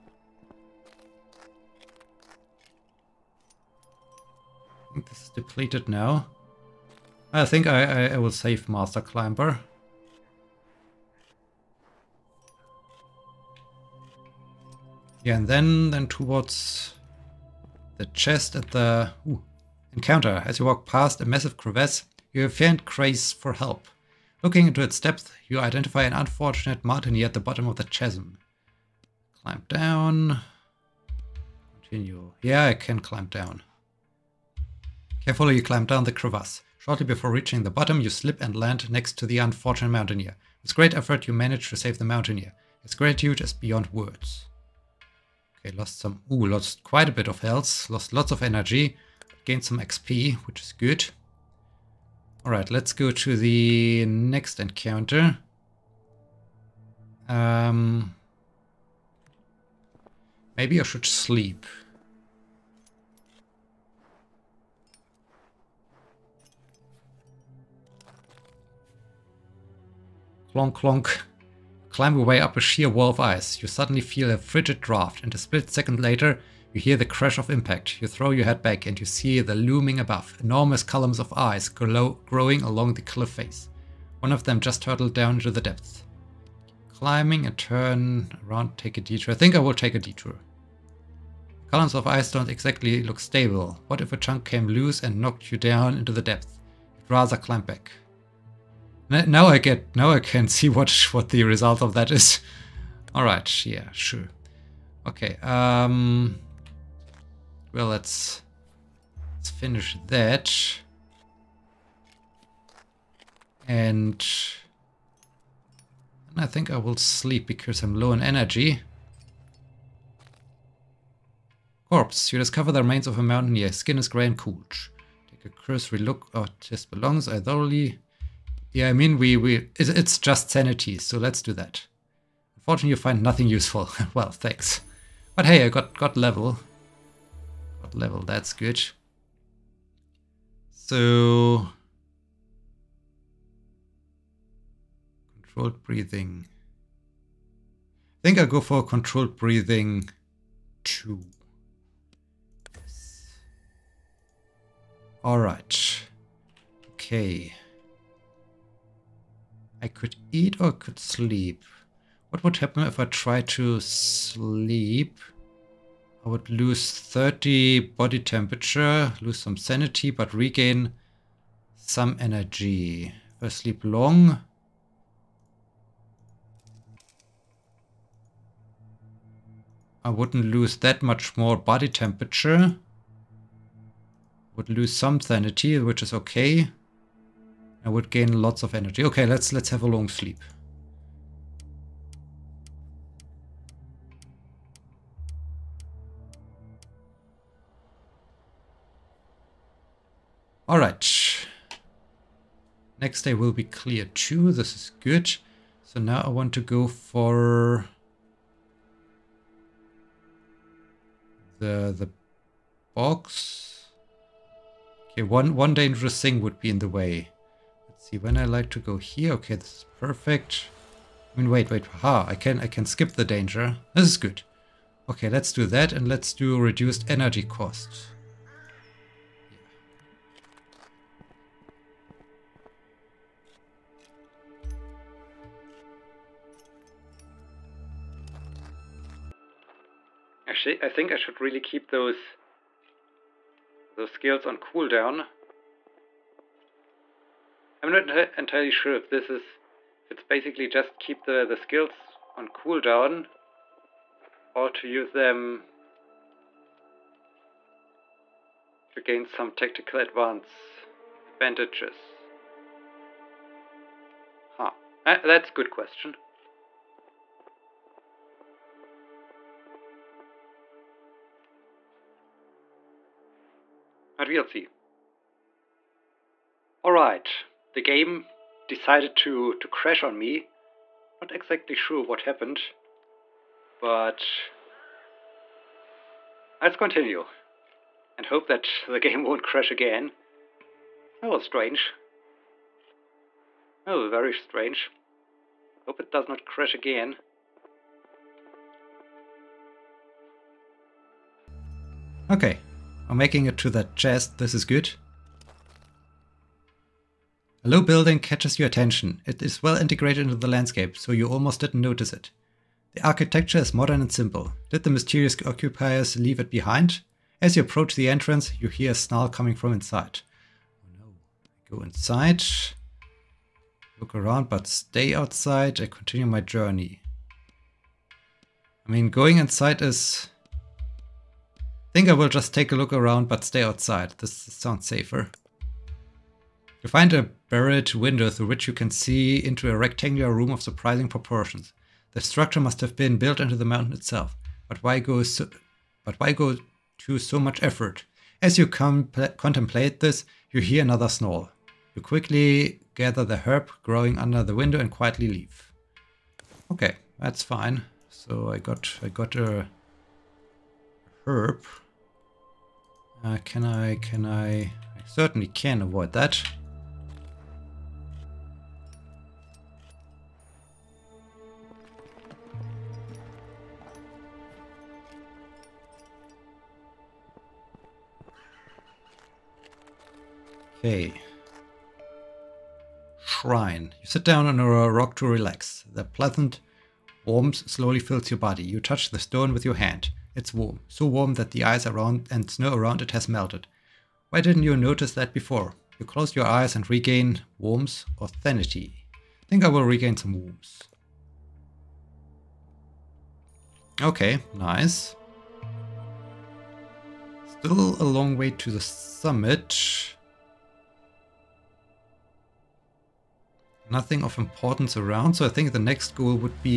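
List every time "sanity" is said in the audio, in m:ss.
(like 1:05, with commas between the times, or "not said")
2:10, 2:49, 3:05, 6:38.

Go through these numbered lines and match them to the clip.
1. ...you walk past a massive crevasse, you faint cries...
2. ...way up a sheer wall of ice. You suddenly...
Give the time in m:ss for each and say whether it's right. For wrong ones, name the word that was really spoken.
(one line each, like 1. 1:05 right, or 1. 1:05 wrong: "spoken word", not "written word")
1. 0:20 right
2. 1:12 right.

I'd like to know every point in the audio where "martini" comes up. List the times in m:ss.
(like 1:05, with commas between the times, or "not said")
0:26.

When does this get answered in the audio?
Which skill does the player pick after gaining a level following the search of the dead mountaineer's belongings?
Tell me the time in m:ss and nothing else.
2:28.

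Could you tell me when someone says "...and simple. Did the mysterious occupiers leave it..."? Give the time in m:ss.
5:13.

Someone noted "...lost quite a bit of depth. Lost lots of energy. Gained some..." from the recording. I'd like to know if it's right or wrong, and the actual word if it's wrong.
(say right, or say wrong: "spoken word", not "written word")
wrong: "health", not "depth".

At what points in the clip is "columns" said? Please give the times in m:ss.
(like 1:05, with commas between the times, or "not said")
1:20, 1:31.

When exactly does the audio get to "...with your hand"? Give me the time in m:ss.
6:29.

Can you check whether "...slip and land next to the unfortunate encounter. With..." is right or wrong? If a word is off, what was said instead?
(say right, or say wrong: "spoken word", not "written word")
wrong: "mountaineer", not "encounter".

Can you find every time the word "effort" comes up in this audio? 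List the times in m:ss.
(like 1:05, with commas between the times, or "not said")
0:40, 5:47.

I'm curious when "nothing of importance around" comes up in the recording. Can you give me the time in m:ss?
6:53.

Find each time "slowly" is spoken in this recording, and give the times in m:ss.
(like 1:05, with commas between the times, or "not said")
6:27.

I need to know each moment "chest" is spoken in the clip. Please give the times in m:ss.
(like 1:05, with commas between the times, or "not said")
0:18, 5:03.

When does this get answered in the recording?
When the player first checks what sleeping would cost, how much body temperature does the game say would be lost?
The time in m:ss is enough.
2:46.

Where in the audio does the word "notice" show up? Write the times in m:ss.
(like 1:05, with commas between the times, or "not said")
5:11, 6:34.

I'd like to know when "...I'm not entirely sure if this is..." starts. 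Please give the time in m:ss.
4:07.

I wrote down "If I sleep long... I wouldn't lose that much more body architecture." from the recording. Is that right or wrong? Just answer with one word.
wrong.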